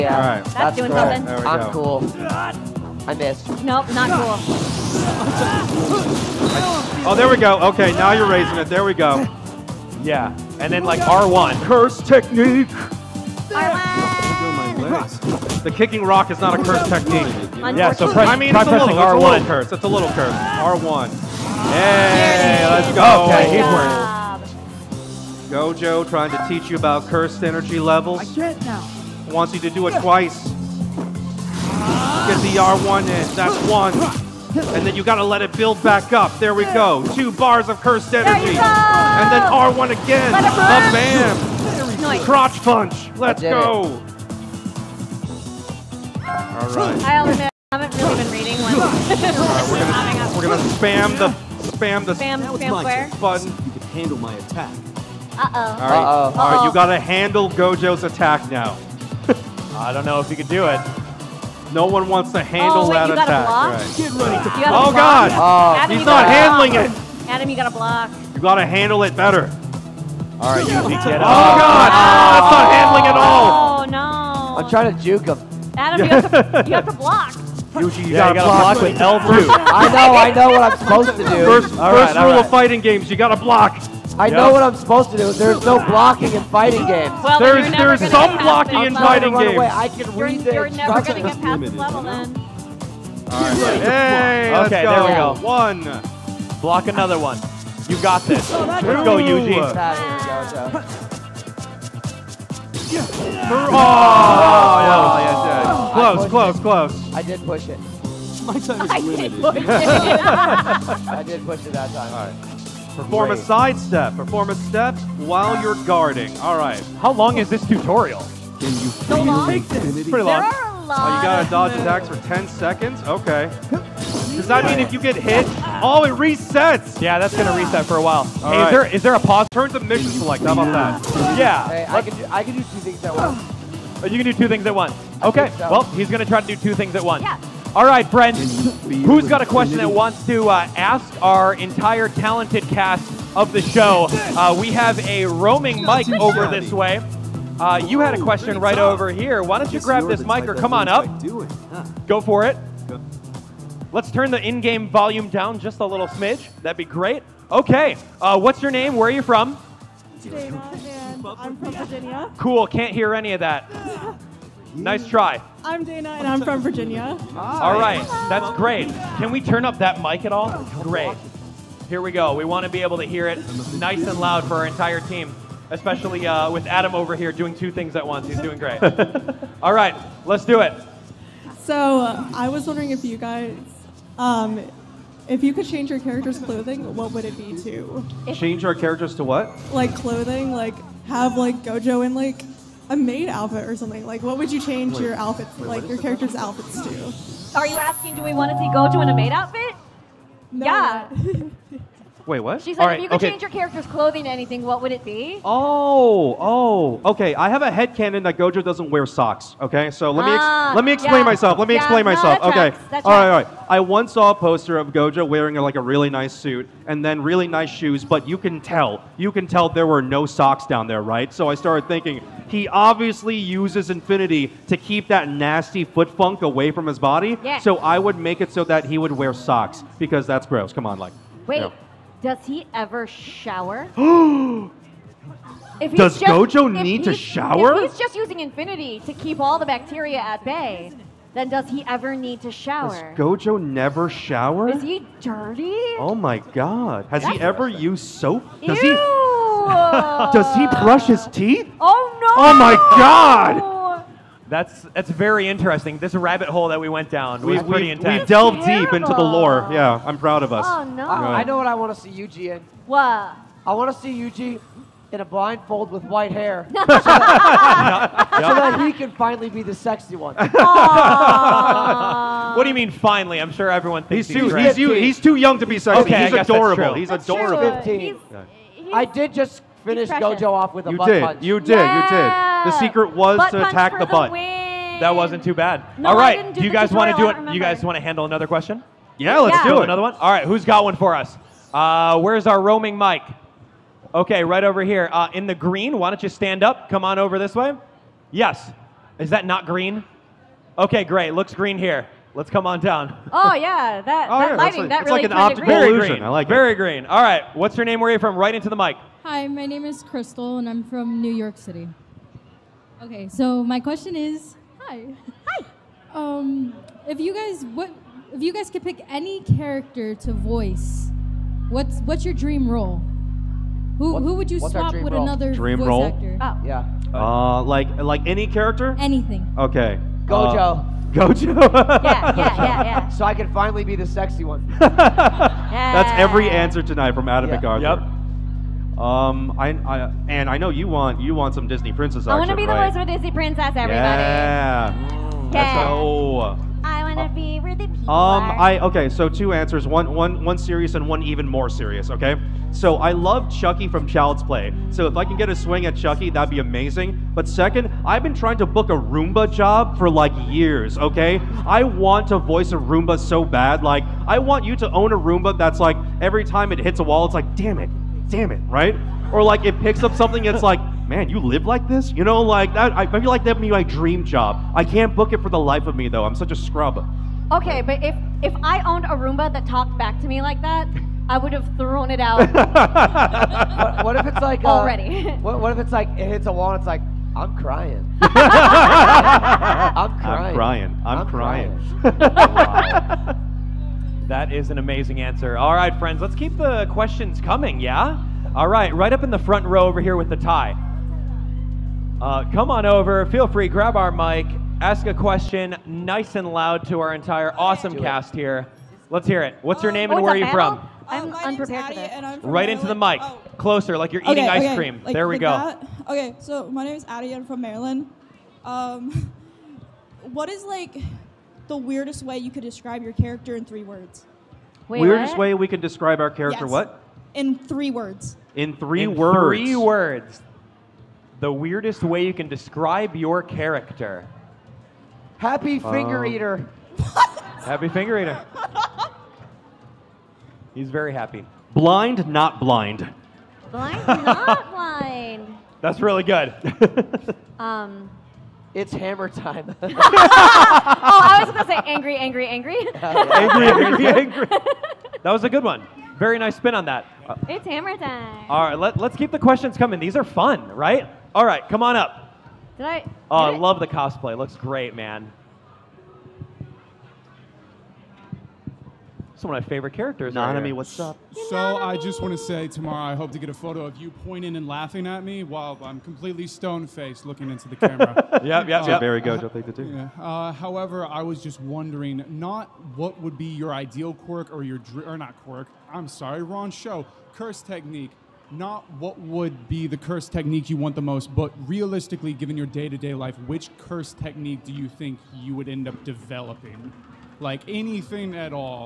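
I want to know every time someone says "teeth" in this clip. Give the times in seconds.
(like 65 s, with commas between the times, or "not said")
251 s.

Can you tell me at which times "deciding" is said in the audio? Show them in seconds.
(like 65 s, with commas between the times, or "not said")
not said.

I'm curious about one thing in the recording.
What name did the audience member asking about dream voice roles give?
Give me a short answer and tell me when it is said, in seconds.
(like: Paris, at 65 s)
Crystal, at 310 s.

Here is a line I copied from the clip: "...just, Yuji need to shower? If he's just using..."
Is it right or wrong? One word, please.
wrong.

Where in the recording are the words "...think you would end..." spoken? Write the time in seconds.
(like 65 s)
494 s.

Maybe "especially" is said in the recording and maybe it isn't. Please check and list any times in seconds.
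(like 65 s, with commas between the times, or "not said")
175 s.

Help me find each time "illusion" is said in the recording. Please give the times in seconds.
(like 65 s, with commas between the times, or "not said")
305 s.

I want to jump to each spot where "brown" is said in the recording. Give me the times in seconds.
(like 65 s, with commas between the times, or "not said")
not said.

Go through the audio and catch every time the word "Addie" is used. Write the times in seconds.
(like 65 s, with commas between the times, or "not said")
411 s, 417 s.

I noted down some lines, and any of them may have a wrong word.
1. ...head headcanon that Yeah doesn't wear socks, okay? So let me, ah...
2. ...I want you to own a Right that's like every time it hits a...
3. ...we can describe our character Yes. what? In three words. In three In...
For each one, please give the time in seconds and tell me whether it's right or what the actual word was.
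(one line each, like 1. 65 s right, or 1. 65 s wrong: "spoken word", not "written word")
1. 207 s wrong: "Gojo", not "Yeah"
2. 364 s wrong: "Roomba", not "Right"
3. 425 s right.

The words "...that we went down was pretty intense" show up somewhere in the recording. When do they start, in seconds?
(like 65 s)
256 s.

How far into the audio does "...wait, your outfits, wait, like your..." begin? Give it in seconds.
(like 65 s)
194 s.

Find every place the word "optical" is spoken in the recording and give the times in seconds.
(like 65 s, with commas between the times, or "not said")
305 s.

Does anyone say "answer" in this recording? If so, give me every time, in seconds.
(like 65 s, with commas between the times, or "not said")
336 s, 349 s, 395 s.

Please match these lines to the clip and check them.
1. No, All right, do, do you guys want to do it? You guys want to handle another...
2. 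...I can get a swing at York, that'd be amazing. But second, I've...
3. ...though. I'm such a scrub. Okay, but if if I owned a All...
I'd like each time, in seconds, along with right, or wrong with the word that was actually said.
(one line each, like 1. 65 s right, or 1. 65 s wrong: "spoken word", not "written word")
1. 285 s right
2. 355 s wrong: "Chucky", not "York"
3. 376 s wrong: "Roomba", not "All".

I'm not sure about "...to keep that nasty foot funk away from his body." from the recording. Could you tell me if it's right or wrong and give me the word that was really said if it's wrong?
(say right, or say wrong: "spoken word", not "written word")
right.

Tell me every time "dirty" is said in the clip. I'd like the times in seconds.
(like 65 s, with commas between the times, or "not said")
245 s.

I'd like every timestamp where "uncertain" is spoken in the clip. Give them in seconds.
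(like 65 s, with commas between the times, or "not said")
not said.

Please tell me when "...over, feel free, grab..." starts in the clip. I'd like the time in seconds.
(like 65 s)
402 s.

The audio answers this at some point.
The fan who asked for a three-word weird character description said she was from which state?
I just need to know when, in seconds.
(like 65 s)
417 s.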